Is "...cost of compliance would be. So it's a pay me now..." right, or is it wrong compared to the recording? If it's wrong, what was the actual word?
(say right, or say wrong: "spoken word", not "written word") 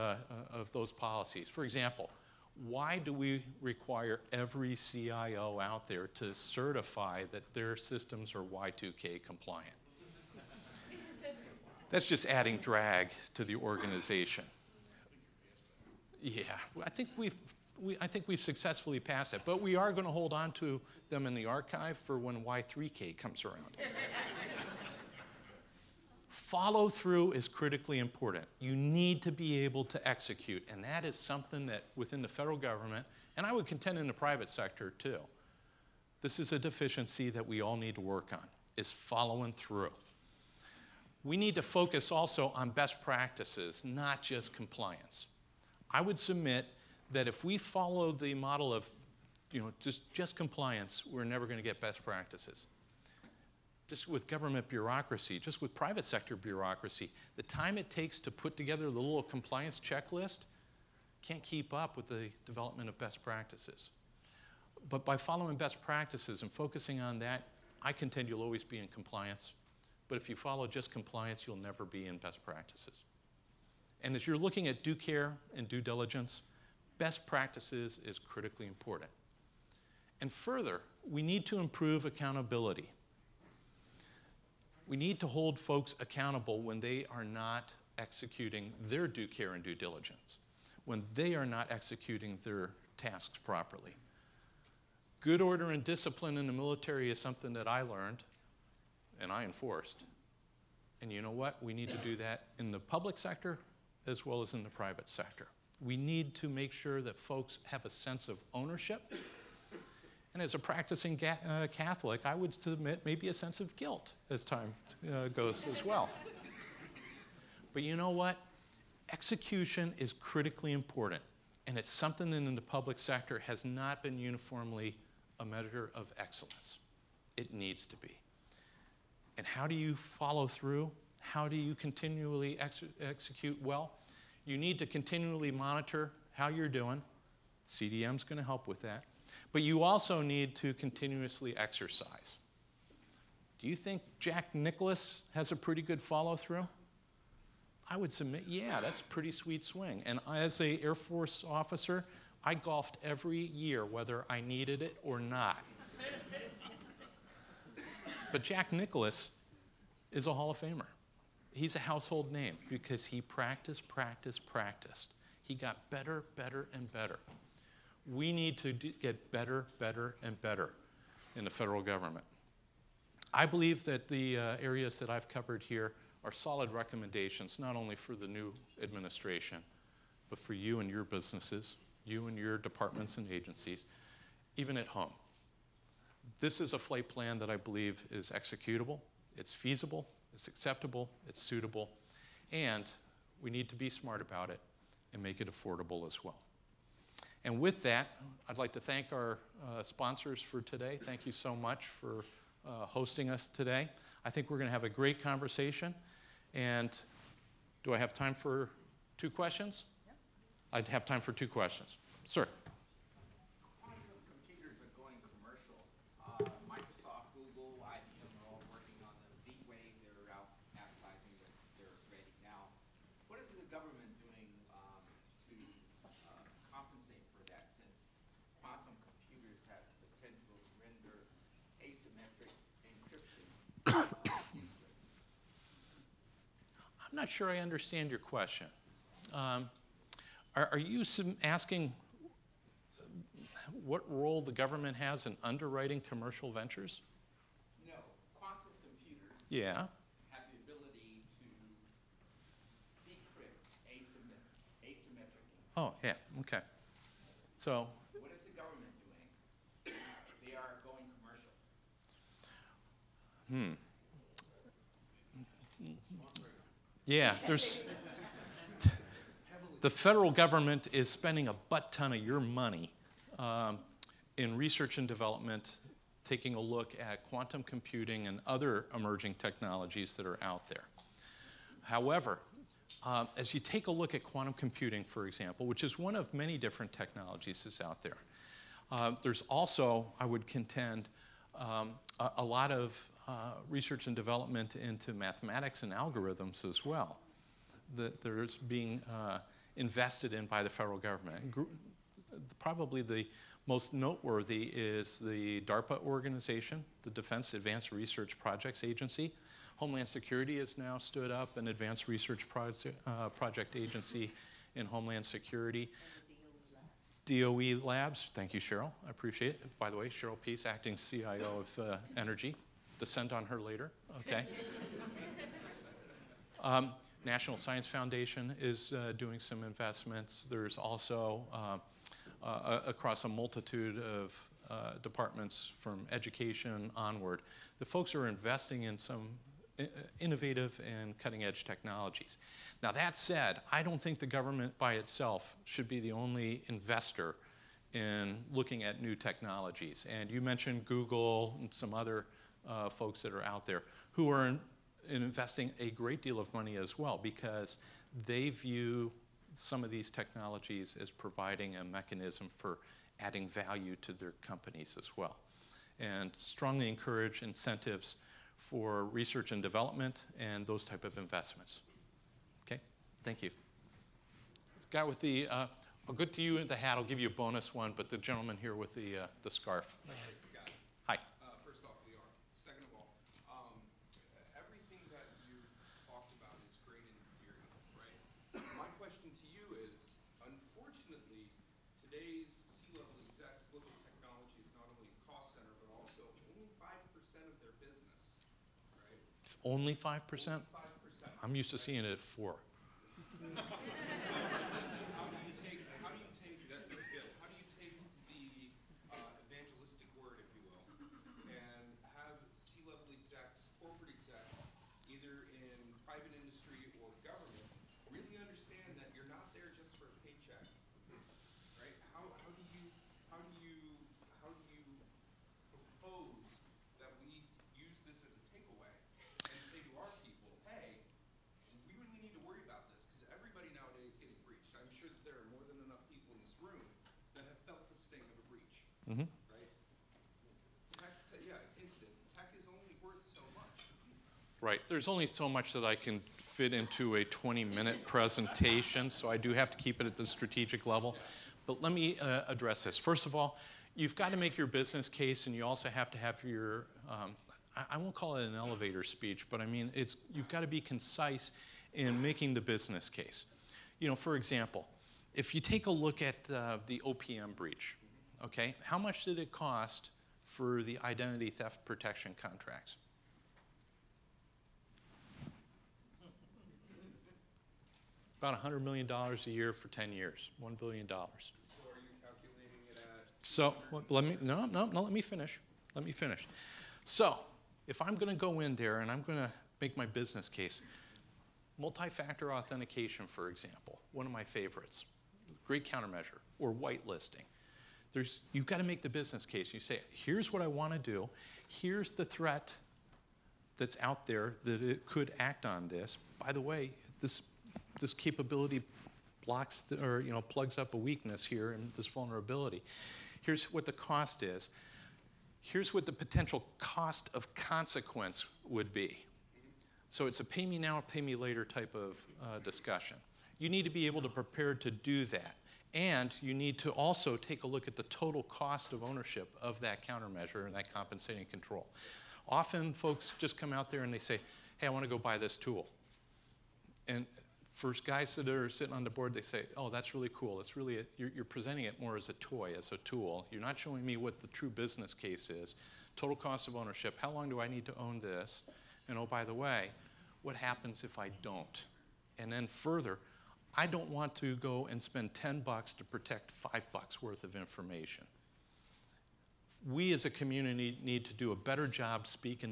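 wrong: "consequence", not "compliance".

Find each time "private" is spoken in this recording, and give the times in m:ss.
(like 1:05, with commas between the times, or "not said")
0:34, 0:55, 1:44.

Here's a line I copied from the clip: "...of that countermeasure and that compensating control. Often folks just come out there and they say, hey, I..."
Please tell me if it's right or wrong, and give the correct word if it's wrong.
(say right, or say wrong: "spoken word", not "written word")
right.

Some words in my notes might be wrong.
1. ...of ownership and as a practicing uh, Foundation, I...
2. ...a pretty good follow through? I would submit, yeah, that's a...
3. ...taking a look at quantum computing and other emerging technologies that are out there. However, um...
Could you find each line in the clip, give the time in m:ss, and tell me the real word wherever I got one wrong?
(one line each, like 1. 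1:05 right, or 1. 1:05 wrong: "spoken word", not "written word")
1. 1:48 wrong: "Catholic", not "Foundation"
2. 2:25 right
3. 4:36 right.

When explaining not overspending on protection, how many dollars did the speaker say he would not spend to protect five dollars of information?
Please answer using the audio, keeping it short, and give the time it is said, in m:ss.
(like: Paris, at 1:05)
10, at 9:15.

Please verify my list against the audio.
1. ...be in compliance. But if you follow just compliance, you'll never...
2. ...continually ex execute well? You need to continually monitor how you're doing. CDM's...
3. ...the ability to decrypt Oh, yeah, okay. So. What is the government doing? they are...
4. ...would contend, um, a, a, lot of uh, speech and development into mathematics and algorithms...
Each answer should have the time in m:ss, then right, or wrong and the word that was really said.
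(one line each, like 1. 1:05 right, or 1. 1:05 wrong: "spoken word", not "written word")
1. 1:08 right
2. 2:11 right
3. 4:10 right
4. 4:50 wrong: "research", not "speech".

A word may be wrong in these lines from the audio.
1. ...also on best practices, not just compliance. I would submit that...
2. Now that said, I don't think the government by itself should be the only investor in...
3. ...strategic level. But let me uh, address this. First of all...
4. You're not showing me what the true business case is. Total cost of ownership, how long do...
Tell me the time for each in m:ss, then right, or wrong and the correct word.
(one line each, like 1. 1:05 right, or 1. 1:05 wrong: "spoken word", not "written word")
1. 0:42 right
2. 5:42 right
3. 7:30 right
4. 9:03 right.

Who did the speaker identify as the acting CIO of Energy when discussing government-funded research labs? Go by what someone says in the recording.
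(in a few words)
Cheryl Peace.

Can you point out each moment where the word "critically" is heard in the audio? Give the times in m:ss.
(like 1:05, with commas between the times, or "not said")
0:27, 1:18, 2:00.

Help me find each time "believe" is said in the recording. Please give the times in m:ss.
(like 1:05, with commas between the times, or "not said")
2:53, 3:07.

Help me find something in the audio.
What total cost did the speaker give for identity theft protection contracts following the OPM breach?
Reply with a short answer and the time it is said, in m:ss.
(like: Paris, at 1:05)
$1 billion, at 8:00.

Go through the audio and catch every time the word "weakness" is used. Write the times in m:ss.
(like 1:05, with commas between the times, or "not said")
8:30.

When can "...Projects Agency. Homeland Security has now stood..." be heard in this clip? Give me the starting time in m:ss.
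5:08.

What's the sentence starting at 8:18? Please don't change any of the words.
There's, you've got to make the business case.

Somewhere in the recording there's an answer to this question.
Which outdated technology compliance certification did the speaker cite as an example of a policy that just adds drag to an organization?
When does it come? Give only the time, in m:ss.
0:08.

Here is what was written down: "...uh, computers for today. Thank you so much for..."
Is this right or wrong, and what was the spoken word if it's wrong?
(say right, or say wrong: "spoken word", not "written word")
wrong: "sponsors", not "computers".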